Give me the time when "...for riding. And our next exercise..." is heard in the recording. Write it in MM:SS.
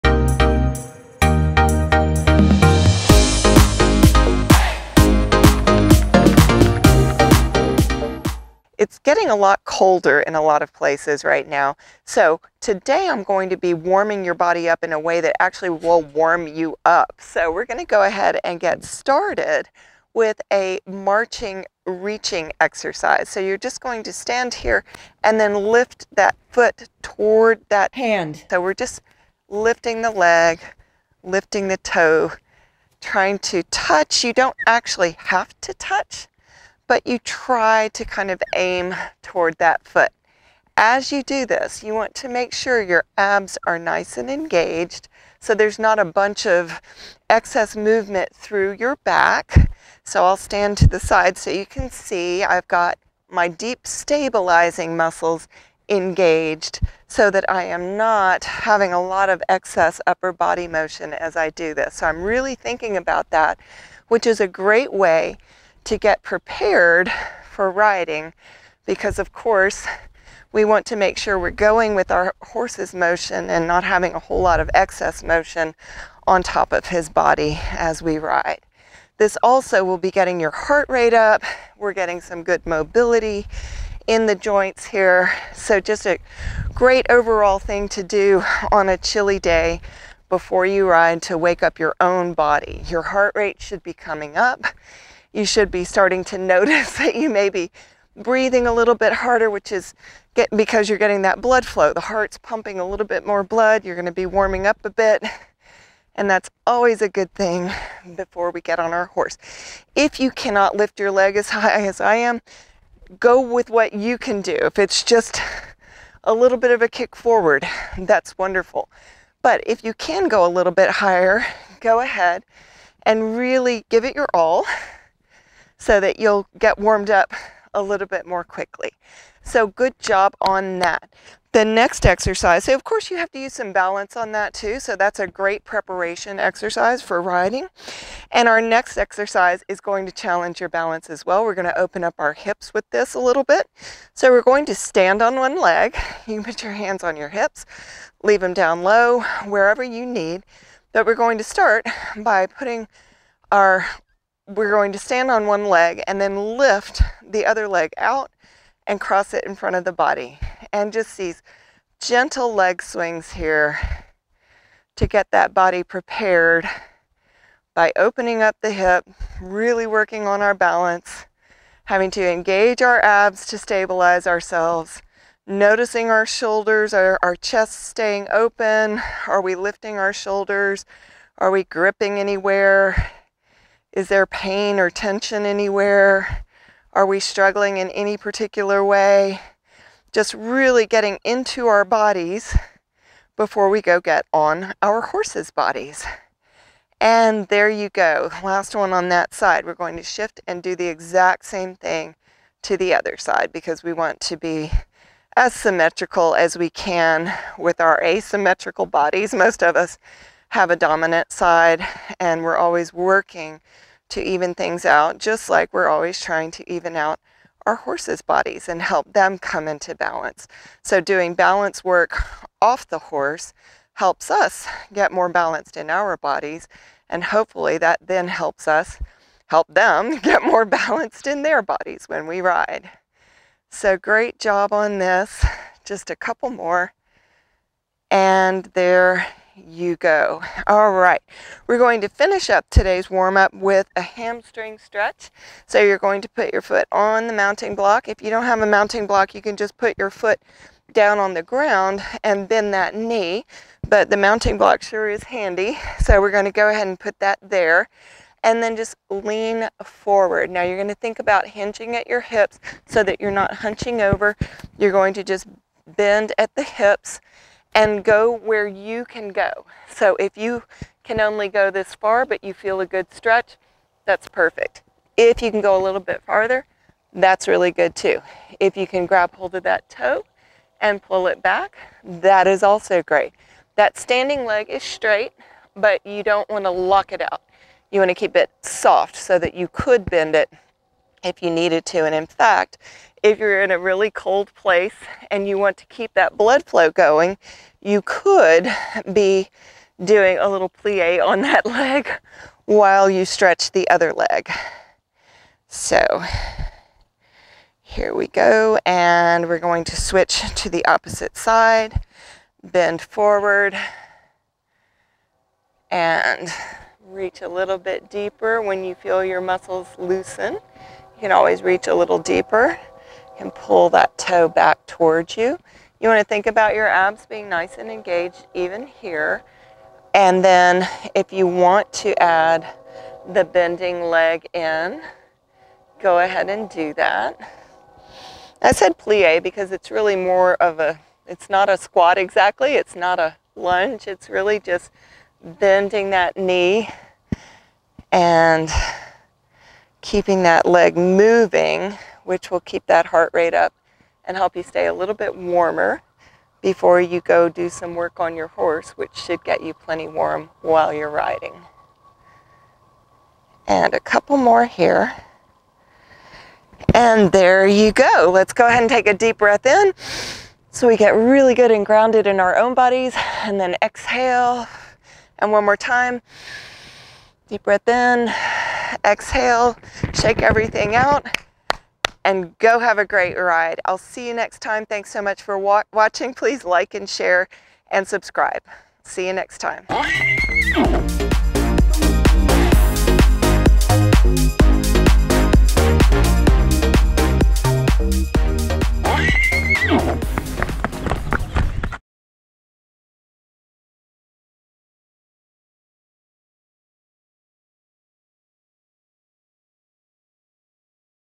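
02:17.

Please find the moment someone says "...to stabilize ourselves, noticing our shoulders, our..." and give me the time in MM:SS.
02:53.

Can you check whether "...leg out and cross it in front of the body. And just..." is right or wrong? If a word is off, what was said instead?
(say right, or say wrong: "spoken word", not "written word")
right.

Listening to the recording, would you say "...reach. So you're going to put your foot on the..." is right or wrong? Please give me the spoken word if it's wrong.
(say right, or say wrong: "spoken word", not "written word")
wrong: "stretch", not "reach".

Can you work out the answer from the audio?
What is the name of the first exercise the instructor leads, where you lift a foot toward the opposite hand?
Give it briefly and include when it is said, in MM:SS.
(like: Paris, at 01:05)
marching reaching, at 00:20.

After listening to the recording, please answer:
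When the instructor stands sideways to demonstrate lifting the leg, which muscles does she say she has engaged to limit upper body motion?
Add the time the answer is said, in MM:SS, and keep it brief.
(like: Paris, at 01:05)
deep stabilizing muscles, at 00:53.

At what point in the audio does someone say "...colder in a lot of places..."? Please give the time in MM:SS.
00:09.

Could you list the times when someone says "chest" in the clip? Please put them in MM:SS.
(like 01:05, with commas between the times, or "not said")
02:57.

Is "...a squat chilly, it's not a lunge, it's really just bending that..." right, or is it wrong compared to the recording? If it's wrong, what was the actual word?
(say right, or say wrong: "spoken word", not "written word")
wrong: "exactly", not "chilly".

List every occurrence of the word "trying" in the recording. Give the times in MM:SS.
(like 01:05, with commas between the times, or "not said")
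00:32, 03:36.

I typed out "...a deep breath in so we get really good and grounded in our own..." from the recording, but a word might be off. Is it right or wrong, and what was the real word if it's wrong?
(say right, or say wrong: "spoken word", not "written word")
right.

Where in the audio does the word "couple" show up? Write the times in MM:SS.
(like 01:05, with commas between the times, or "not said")
03:56, 06:03.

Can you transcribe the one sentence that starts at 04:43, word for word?
That standing leg is straight, but you don't want to lock it out.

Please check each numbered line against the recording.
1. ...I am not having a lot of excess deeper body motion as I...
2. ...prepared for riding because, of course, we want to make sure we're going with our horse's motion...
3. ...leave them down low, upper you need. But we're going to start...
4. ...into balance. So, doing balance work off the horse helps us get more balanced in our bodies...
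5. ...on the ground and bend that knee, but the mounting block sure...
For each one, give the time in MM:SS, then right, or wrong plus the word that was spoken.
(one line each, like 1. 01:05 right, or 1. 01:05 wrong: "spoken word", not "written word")
1. 00:57 wrong: "upper", not "deeper"
2. 01:06 right
3. 02:28 wrong: "wherever", not "upper"
4. 03:39 right
5. 04:11 right.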